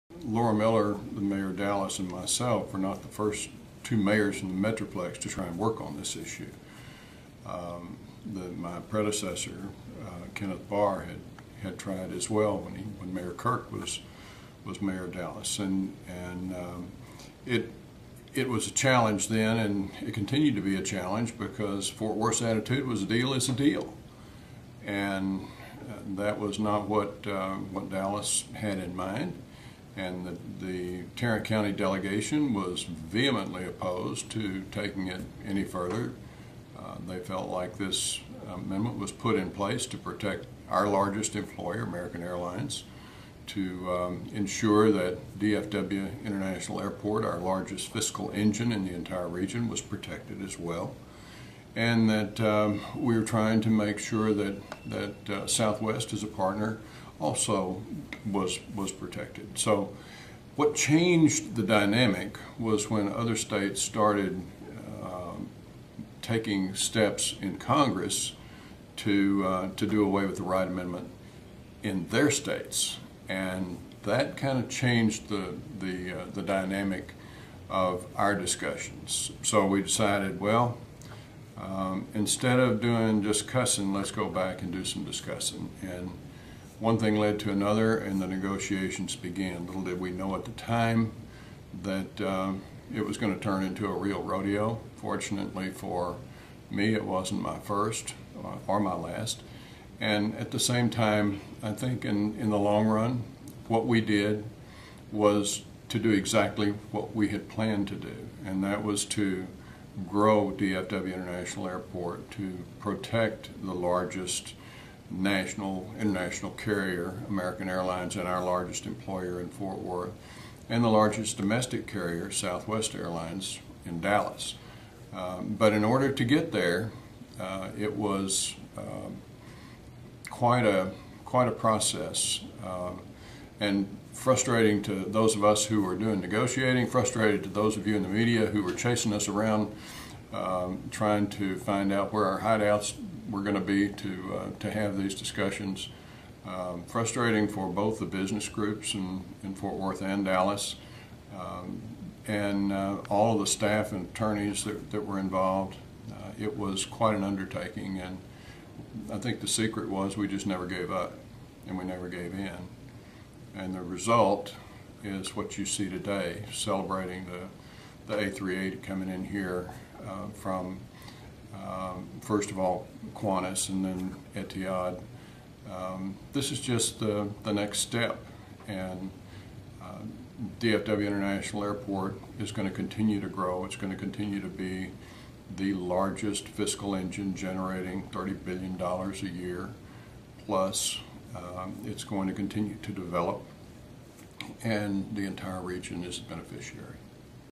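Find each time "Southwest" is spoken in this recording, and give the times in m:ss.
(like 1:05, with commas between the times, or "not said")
0:55, 2:02.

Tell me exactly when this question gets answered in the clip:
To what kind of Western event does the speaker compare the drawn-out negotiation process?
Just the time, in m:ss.
1:34.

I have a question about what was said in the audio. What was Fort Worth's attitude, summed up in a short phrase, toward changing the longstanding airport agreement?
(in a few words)
a deal is a deal.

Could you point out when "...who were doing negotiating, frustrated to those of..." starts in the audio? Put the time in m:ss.
2:15.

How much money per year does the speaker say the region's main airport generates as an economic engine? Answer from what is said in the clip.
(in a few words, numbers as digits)
$30 billion.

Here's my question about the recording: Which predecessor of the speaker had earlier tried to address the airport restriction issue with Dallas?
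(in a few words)
Kenneth Barr.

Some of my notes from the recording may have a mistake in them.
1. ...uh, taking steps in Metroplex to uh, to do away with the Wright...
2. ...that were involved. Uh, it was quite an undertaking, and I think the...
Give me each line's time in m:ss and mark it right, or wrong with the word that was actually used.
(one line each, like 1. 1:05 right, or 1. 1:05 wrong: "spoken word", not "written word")
1. 1:05 wrong: "Congress", not "Metroplex"
2. 2:34 right.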